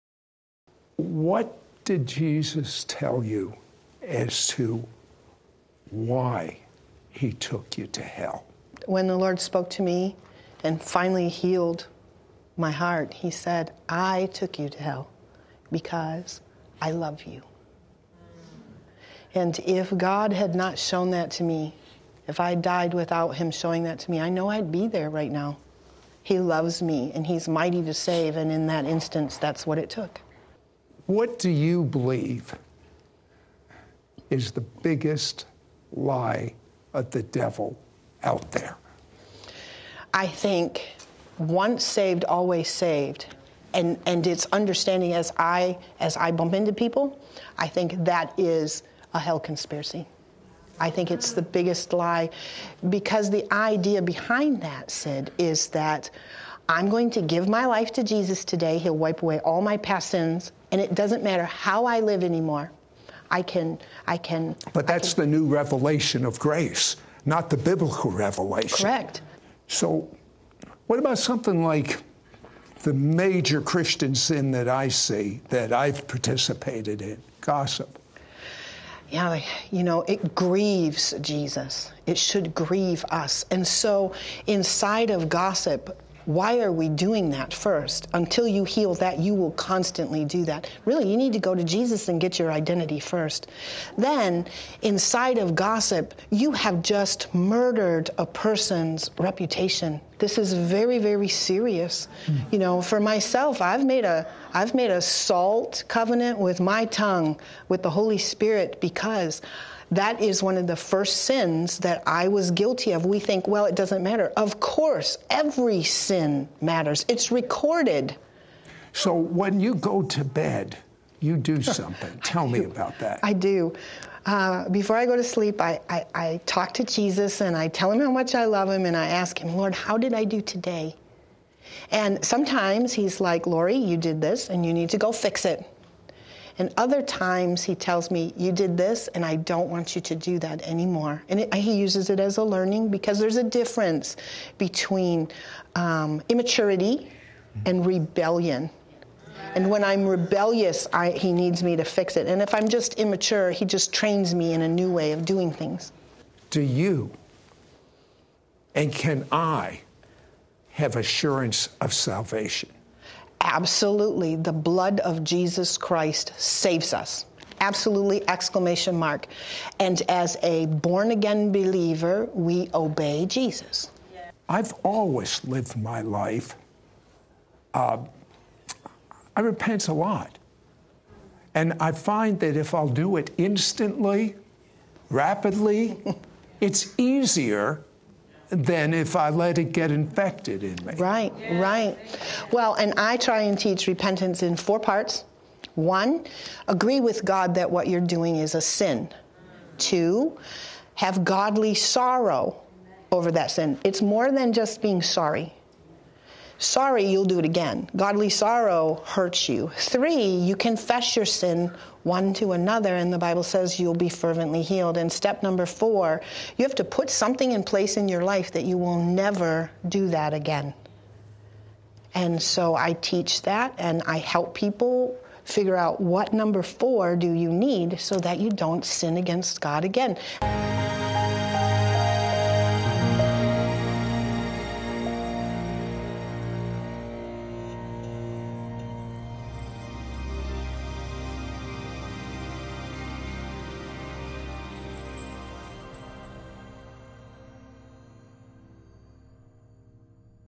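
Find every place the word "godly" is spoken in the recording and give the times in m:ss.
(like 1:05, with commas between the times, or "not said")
3:21, 3:27.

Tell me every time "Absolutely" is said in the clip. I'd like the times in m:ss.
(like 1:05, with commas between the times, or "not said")
2:43, 2:47.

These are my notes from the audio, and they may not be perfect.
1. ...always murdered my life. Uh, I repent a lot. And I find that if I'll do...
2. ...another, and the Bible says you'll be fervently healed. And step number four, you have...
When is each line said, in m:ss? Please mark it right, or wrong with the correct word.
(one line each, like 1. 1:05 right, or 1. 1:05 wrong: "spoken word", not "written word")
1. 2:54 wrong: "lived", not "murdered"
2. 3:32 right.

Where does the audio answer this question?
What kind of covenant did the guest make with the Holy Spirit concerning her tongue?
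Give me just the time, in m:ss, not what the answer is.
1:45.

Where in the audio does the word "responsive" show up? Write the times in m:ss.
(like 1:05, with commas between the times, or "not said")
not said.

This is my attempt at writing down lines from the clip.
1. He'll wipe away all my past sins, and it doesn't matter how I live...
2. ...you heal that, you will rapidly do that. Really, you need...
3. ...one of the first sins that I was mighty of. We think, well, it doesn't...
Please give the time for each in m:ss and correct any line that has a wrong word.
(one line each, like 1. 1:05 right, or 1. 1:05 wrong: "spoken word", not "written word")
1. 0:58 right
2. 1:28 wrong: "constantly", not "rapidly"
3. 1:50 wrong: "guilty", not "mighty".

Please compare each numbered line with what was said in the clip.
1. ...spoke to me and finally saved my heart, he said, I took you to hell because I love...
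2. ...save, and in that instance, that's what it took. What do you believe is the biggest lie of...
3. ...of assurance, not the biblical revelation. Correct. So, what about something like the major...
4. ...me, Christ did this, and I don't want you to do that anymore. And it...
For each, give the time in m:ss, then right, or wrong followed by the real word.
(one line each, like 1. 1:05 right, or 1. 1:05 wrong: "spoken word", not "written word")
1. 0:09 wrong: "healed", not "saved"
2. 0:27 right
3. 1:06 wrong: "grace", not "assurance"
4. 2:18 wrong: "You", not "Christ".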